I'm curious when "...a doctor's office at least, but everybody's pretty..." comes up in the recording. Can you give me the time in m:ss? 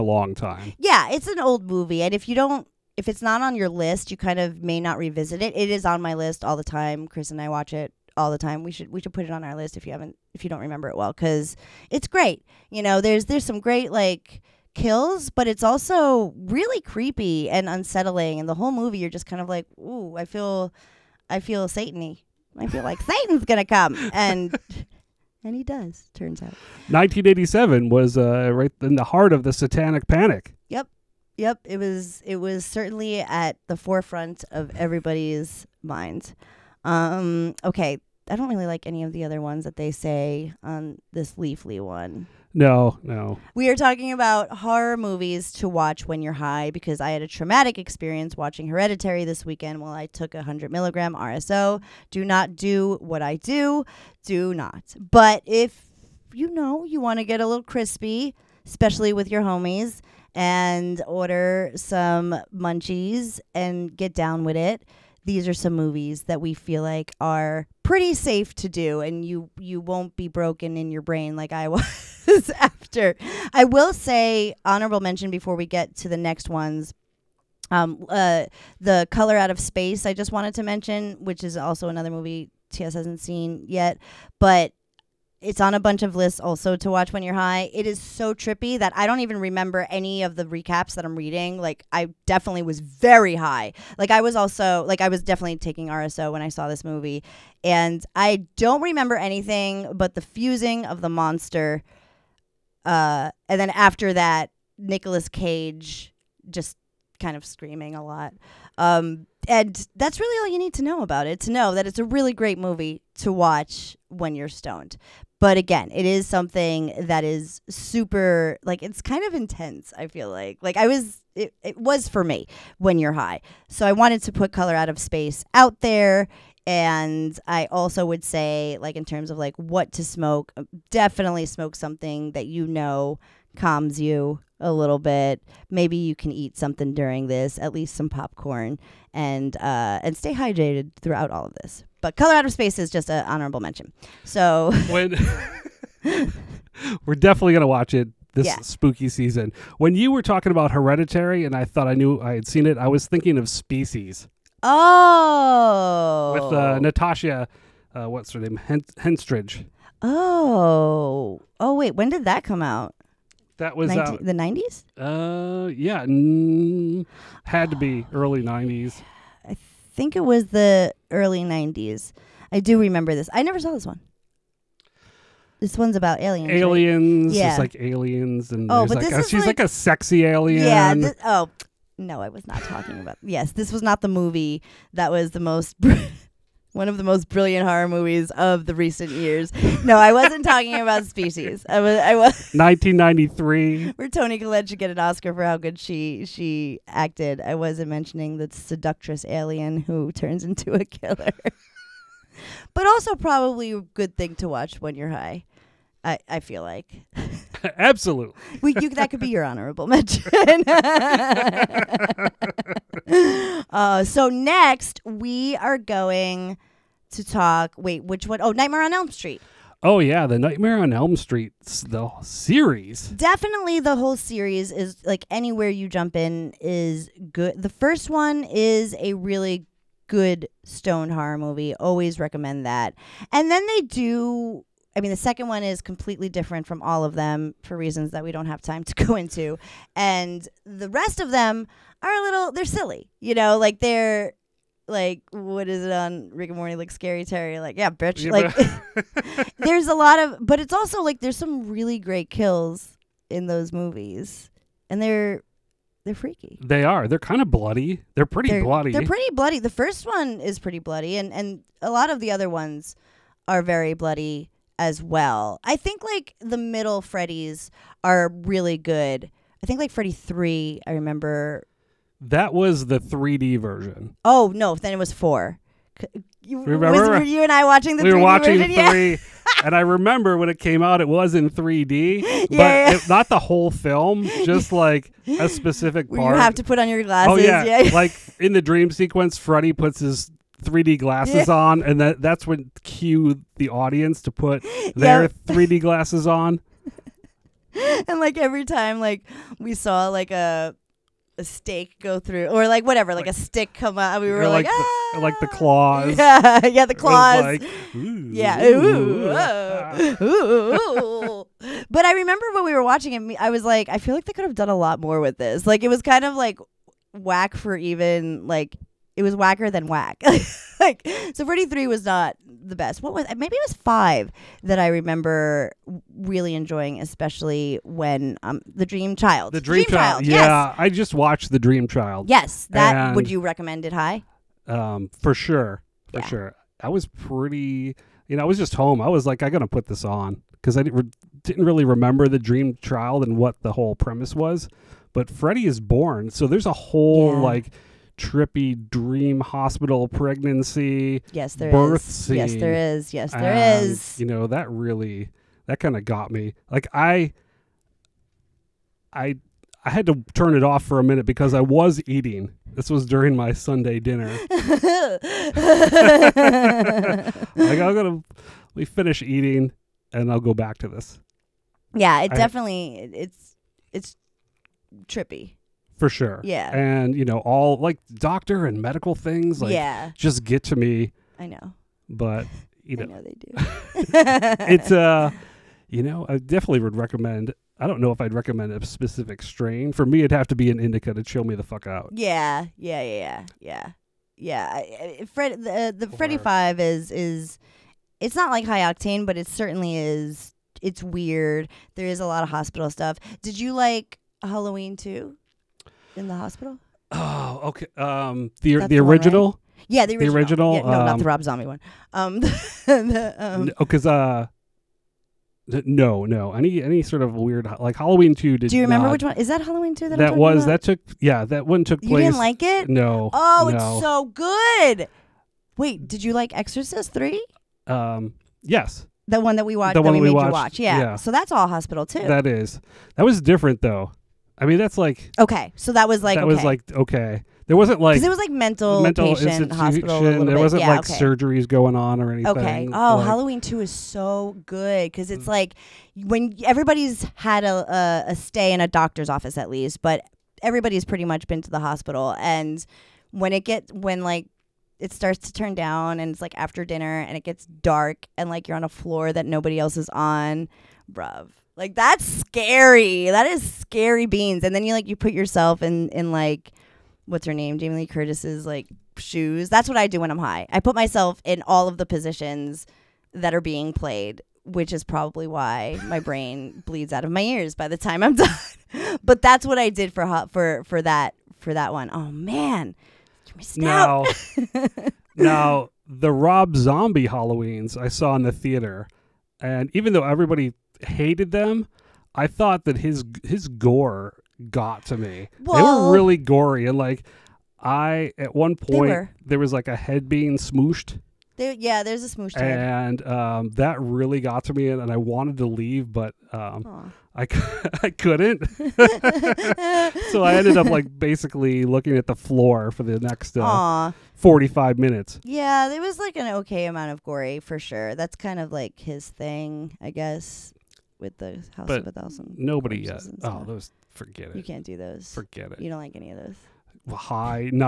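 7:28.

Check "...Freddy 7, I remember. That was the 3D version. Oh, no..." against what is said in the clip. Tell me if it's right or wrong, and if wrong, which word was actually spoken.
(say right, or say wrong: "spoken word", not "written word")
wrong: "3", not "7".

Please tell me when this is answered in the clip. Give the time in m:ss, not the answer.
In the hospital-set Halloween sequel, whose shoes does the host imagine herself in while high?
7:47.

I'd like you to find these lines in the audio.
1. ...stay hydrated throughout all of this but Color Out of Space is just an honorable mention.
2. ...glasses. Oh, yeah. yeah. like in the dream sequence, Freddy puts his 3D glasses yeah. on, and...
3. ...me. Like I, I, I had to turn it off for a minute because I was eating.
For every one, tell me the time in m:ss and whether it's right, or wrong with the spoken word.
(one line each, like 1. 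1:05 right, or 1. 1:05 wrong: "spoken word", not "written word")
1. 2:20 right
2. 4:47 right
3. 5:56 right.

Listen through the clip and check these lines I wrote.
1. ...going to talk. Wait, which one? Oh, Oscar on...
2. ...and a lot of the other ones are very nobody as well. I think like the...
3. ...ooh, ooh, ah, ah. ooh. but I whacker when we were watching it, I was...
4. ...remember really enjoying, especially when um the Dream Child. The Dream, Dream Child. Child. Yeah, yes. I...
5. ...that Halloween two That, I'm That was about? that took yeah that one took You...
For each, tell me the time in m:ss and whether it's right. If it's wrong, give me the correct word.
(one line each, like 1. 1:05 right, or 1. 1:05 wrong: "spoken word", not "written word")
1. 3:35 wrong: "Nightmare", not "Oscar"
2. 4:21 wrong: "bloody", not "nobody"
3. 5:08 wrong: "remember", not "whacker"
4. 5:24 right
5. 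6:59 right.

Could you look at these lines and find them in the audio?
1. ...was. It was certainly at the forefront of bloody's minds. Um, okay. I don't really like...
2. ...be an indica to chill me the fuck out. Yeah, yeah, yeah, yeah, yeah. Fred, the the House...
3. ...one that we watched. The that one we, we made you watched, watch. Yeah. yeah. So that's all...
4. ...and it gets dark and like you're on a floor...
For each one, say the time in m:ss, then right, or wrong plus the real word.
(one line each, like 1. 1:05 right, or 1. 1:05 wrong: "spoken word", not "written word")
1. 0:31 wrong: "everybody", not "bloody"
2. 6:30 wrong: "Freddy", not "House"
3. 7:09 right
4. 7:37 right.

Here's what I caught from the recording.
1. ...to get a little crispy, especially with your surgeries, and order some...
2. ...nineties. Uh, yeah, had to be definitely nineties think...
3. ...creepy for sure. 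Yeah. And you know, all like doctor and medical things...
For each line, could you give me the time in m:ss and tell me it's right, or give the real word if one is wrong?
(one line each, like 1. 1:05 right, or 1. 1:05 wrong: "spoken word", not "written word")
1. 0:57 wrong: "homies", not "surgeries"
2. 2:44 wrong: "early", not "definitely"
3. 6:15 wrong: "trippy", not "creepy".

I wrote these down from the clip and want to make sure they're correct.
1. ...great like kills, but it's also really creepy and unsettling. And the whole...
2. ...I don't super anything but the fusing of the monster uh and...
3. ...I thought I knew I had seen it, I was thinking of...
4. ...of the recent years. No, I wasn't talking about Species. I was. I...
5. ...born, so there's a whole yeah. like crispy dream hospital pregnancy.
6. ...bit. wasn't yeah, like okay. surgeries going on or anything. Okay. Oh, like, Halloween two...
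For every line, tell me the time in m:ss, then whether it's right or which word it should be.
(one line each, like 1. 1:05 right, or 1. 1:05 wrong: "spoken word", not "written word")
1. 0:13 right
2. 1:38 wrong: "remember", not "super"
3. 2:31 right
4. 3:08 right
5. 5:45 wrong: "trippy", not "crispy"
6. 7:20 right.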